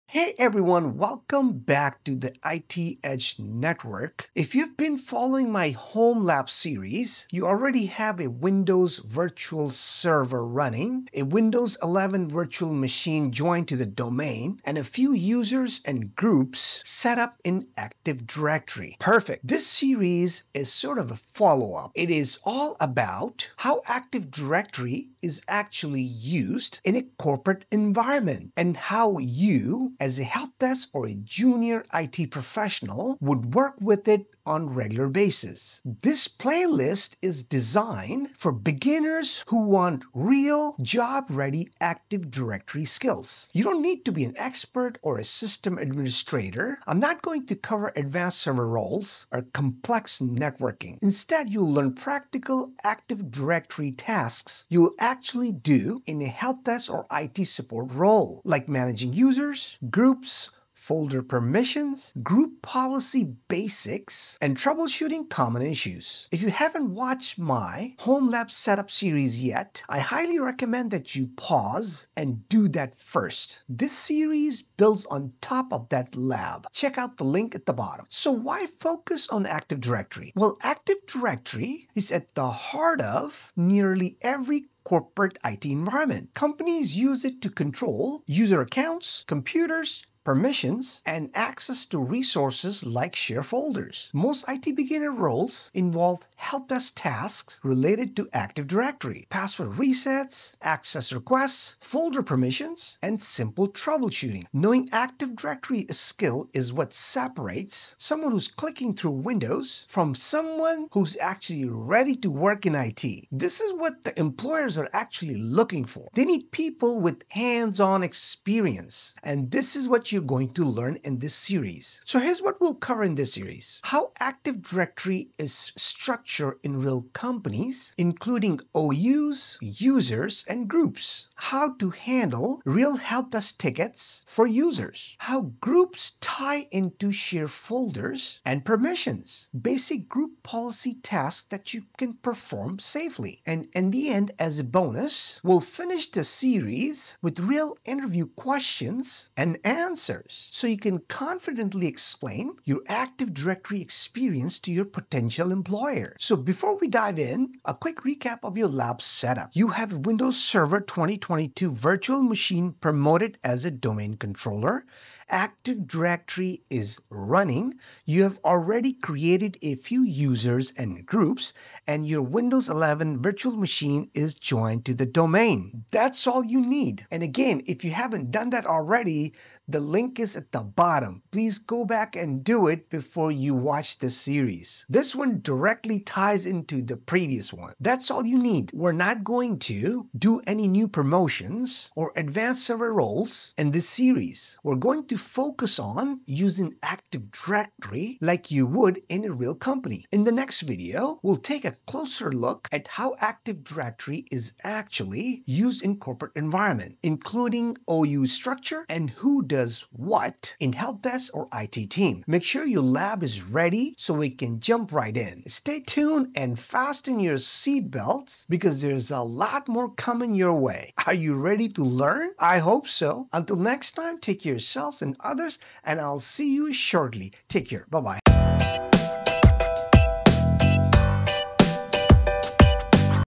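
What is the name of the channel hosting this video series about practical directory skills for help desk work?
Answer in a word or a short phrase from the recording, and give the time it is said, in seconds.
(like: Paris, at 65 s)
IT Edge Network, at 2 s.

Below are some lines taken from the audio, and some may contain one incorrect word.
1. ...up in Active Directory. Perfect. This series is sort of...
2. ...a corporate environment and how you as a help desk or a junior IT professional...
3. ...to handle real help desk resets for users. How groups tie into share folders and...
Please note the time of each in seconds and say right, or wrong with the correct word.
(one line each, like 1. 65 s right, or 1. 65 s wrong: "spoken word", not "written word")
1. 17 s right
2. 26 s right
3. 131 s wrong: "tickets", not "resets".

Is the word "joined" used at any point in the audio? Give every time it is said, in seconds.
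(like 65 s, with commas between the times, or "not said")
13 s, 174 s.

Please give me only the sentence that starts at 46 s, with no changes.
I'm not going to cover advanced server roles or complex networking.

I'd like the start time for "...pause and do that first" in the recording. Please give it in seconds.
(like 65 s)
71 s.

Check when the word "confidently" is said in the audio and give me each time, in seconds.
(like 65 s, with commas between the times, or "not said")
151 s.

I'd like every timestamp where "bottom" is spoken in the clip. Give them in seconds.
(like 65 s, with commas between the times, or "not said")
77 s, 180 s.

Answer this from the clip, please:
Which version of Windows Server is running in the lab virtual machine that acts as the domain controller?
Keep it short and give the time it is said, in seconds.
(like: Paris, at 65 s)
2022, at 160 s.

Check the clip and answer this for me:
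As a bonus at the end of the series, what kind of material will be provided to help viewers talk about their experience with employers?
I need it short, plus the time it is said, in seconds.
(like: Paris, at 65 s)
Interview questions and answers, at 147 s.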